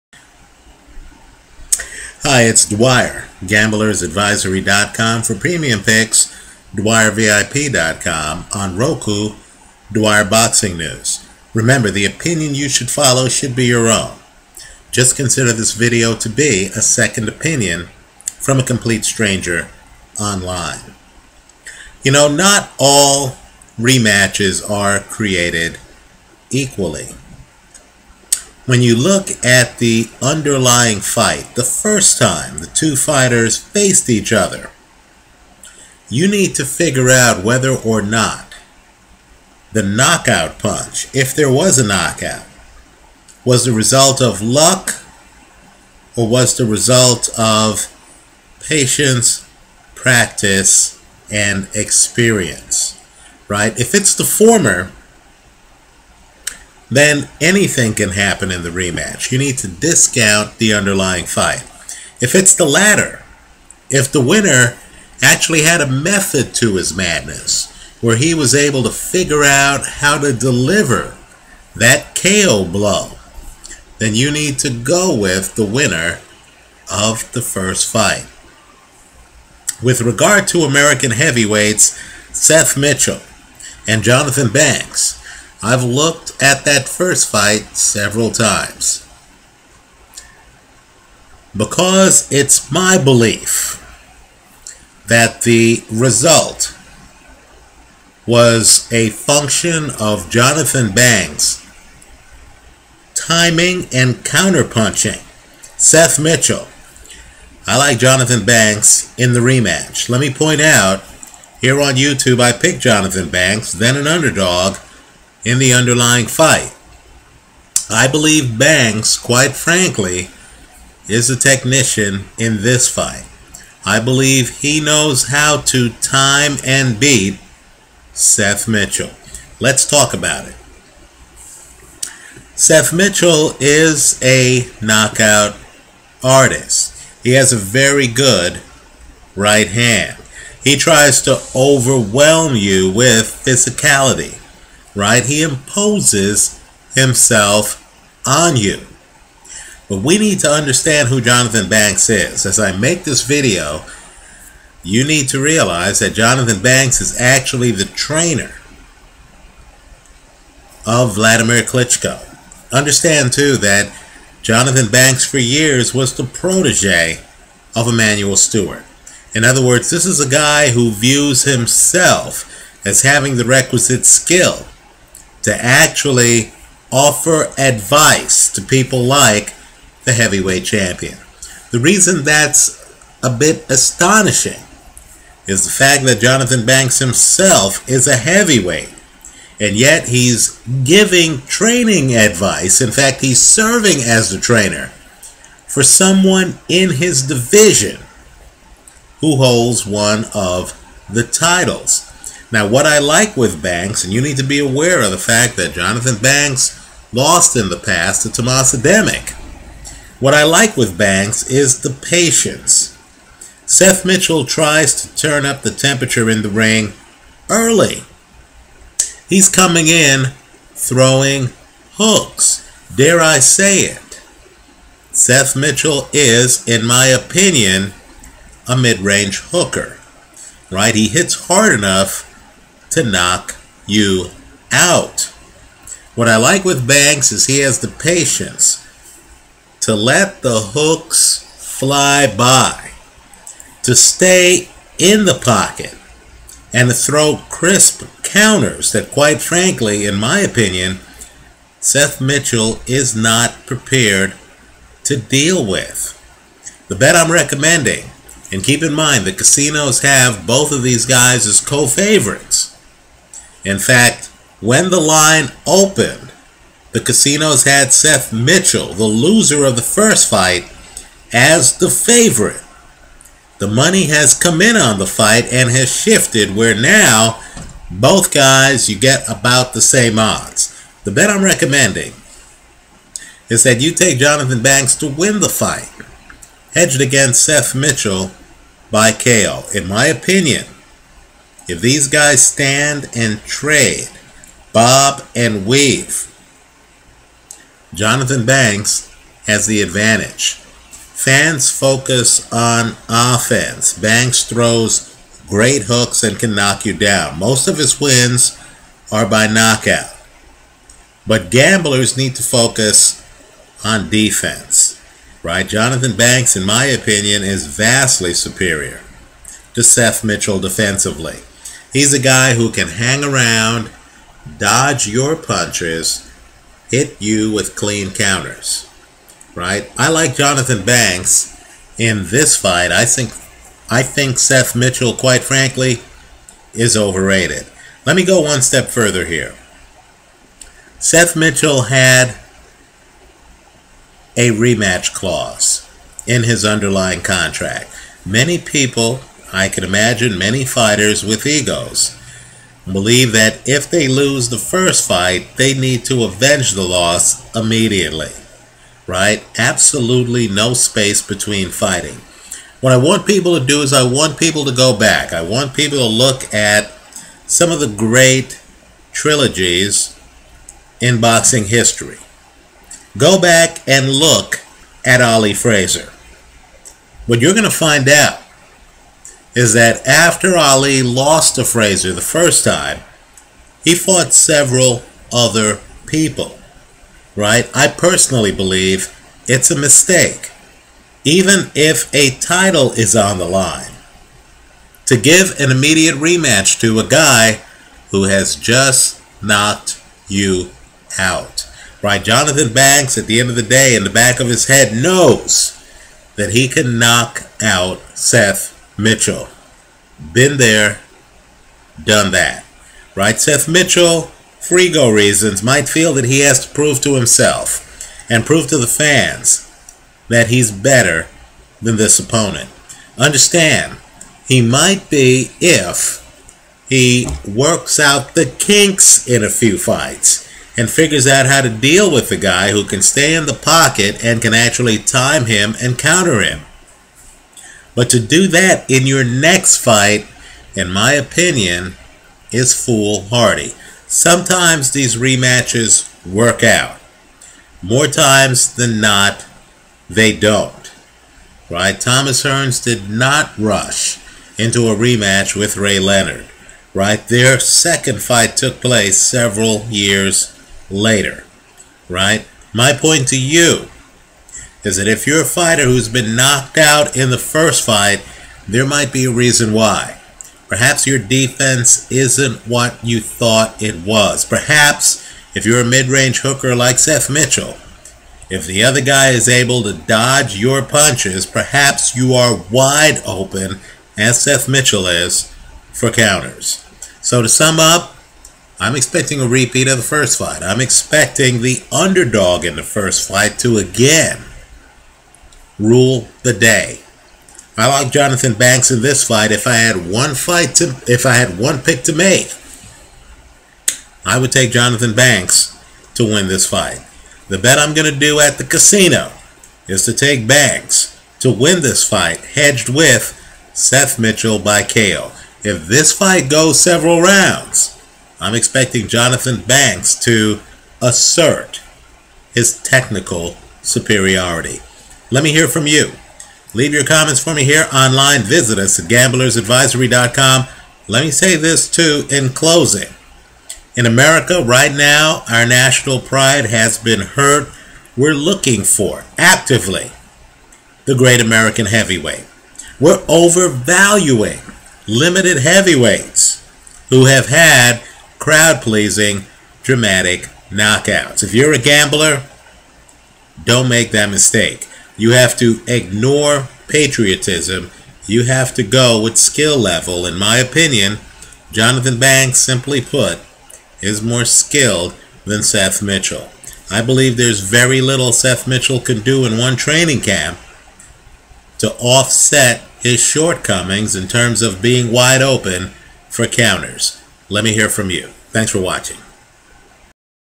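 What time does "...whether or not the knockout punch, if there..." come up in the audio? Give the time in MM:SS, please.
00:37.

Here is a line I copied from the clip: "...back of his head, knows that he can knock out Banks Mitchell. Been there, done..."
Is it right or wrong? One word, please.
wrong.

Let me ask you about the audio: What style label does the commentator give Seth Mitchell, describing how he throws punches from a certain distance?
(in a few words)
mid range hooker.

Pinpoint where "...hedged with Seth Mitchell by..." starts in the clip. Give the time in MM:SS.
08:32.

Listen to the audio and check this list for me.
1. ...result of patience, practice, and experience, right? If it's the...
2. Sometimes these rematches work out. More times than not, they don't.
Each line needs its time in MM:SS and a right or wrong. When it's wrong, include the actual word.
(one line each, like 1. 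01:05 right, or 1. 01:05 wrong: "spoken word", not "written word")
1. 00:46 right
2. 07:24 right.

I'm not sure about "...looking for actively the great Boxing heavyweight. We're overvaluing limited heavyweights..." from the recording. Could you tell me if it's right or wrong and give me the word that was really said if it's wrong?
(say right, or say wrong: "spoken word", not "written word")
wrong: "American", not "Boxing".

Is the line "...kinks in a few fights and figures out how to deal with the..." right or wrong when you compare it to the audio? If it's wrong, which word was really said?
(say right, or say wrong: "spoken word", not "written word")
right.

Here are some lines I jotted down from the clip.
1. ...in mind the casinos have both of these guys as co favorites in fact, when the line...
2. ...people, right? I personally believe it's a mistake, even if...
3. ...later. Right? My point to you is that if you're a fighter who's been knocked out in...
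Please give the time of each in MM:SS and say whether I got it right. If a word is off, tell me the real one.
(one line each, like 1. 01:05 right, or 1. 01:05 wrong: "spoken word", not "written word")
1. 04:18 right
2. 06:26 right
3. 07:40 right.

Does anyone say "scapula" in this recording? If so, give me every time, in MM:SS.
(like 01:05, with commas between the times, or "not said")
not said.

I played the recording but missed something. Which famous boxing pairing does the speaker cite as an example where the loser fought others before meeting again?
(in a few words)
Ali Frazier.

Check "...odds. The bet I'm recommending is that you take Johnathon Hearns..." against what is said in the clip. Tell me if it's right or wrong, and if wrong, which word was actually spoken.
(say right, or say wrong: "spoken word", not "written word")
wrong: "Banks", not "Hearns".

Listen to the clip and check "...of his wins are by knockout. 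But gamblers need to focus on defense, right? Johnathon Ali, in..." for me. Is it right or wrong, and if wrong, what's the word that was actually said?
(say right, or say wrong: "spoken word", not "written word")
wrong: "Banks", not "Ali".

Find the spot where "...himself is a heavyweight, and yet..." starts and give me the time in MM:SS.
03:06.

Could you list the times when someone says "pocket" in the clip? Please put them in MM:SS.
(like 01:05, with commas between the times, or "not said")
04:05, 07:13.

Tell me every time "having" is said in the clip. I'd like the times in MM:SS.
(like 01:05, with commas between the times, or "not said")
02:53.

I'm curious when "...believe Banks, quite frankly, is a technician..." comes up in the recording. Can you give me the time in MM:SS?
01:58.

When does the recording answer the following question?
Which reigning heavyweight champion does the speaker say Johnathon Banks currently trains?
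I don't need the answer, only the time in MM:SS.
02:41.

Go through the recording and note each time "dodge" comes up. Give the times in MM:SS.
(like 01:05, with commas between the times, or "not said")
05:24, 07:59.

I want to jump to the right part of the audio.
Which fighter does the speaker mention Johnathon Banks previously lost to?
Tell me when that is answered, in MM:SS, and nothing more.
03:28.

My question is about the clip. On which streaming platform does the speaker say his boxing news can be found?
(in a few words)
Roku.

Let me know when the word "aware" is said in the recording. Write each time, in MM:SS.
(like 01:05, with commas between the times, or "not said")
03:24.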